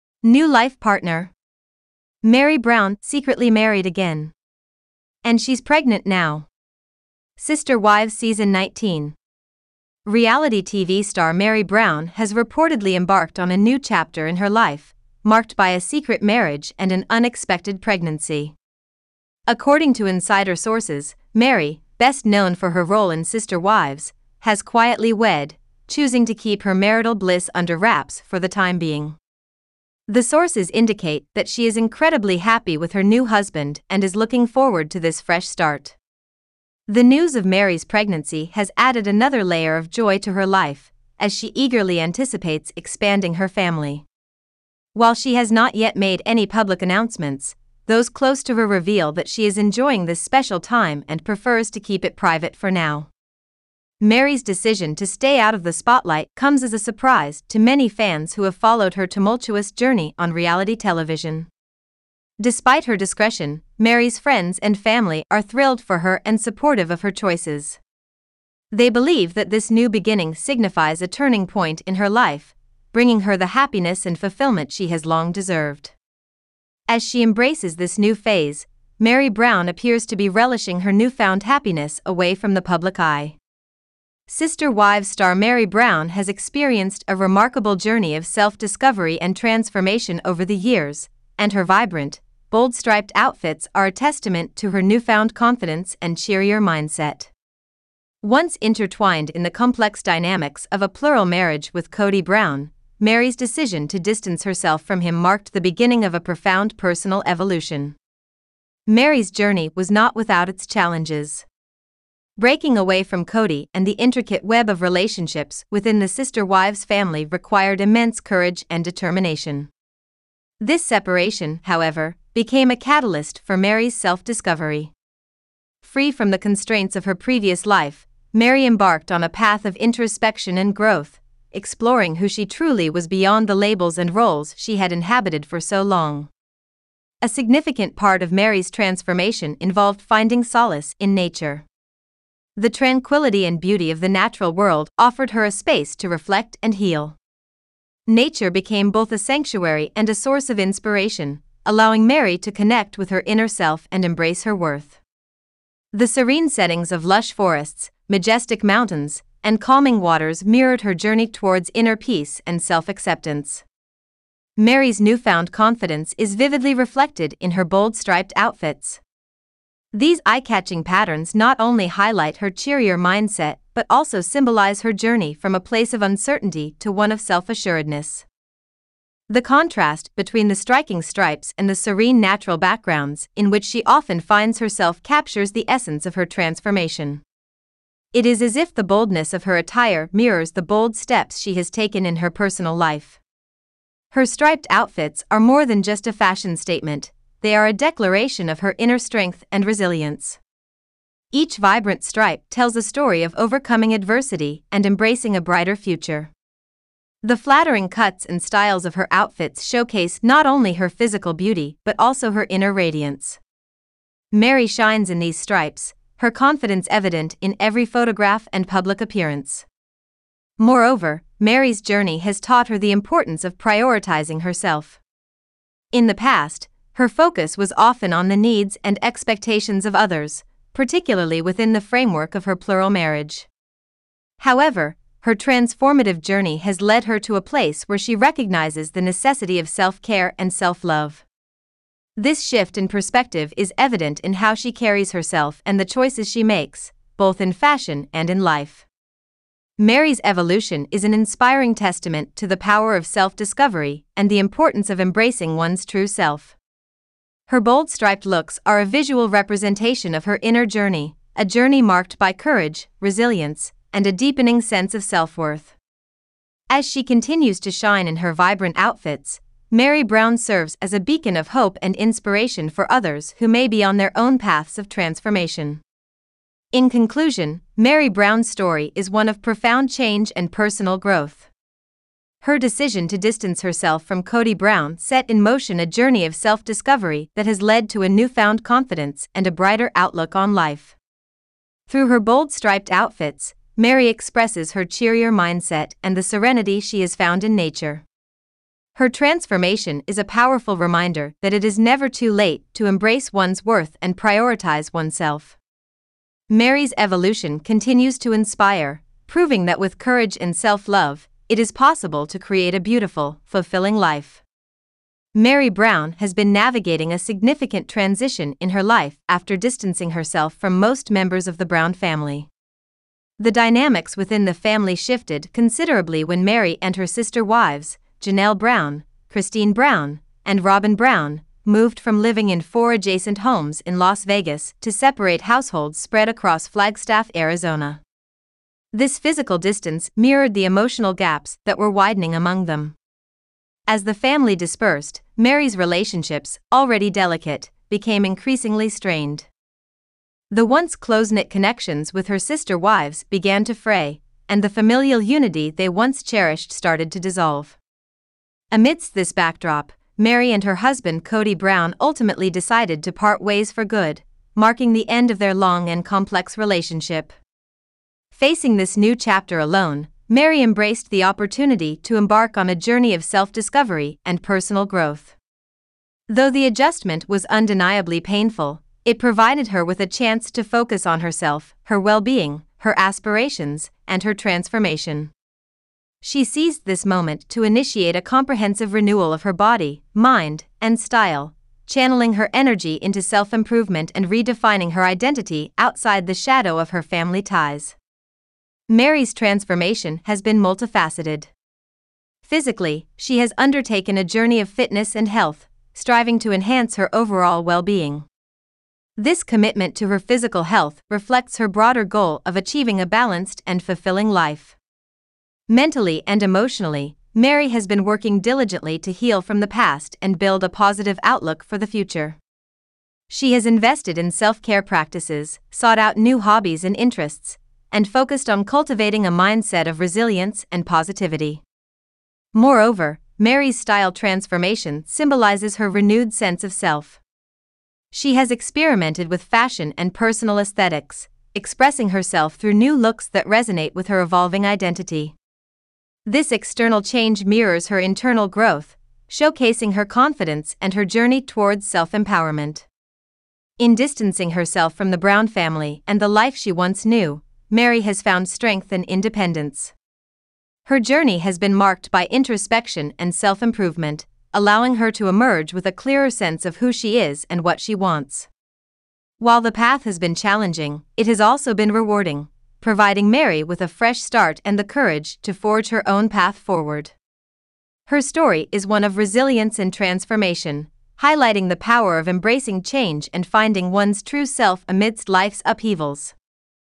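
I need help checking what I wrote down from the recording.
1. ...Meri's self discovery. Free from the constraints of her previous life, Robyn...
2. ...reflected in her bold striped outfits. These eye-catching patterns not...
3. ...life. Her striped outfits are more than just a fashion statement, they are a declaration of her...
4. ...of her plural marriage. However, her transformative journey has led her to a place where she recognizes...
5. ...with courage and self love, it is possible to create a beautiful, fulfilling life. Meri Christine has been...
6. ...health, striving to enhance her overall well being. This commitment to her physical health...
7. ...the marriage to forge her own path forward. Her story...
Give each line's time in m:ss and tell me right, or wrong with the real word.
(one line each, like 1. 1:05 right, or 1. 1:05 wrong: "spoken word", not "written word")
1. 2:03 wrong: "Meri", not "Robyn"
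2. 2:46 right
3. 3:12 right
4. 3:52 right
5. 5:09 wrong: "Brown", not "Christine"
6. 6:45 right
7. 7:54 wrong: "courage", not "marriage".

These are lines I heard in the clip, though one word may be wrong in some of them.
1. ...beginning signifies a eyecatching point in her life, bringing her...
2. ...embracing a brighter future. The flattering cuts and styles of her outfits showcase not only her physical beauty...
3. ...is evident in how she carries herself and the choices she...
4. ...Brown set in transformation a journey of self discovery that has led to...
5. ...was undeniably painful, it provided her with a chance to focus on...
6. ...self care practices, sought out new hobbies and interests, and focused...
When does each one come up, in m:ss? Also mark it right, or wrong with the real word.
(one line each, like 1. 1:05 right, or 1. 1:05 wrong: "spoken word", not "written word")
1. 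1:09 wrong: "turning", not "eyecatching"
2. 3:24 right
3. 4:03 right
4. 4:44 wrong: "motion", not "transformation"
5. 6:17 right
6. 7:04 right.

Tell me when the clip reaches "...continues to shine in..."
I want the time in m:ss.
4:27.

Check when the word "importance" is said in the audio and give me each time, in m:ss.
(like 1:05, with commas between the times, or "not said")
3:42, 4:14.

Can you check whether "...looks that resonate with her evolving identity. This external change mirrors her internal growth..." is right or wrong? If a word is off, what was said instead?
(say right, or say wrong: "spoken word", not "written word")
right.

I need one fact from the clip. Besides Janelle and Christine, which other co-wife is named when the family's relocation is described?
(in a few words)
Robyn Brown.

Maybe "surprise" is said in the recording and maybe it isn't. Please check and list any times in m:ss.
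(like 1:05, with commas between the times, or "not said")
0:56.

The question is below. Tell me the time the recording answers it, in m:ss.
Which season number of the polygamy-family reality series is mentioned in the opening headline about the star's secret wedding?
0:08.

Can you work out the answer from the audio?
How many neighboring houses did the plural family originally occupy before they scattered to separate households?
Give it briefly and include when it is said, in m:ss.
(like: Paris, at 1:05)
4, at 5:32.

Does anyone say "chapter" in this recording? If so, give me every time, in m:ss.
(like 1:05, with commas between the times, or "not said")
0:13, 6:09.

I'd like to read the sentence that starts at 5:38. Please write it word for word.
This physical distance mirrored the emotional gaps that were widening among them.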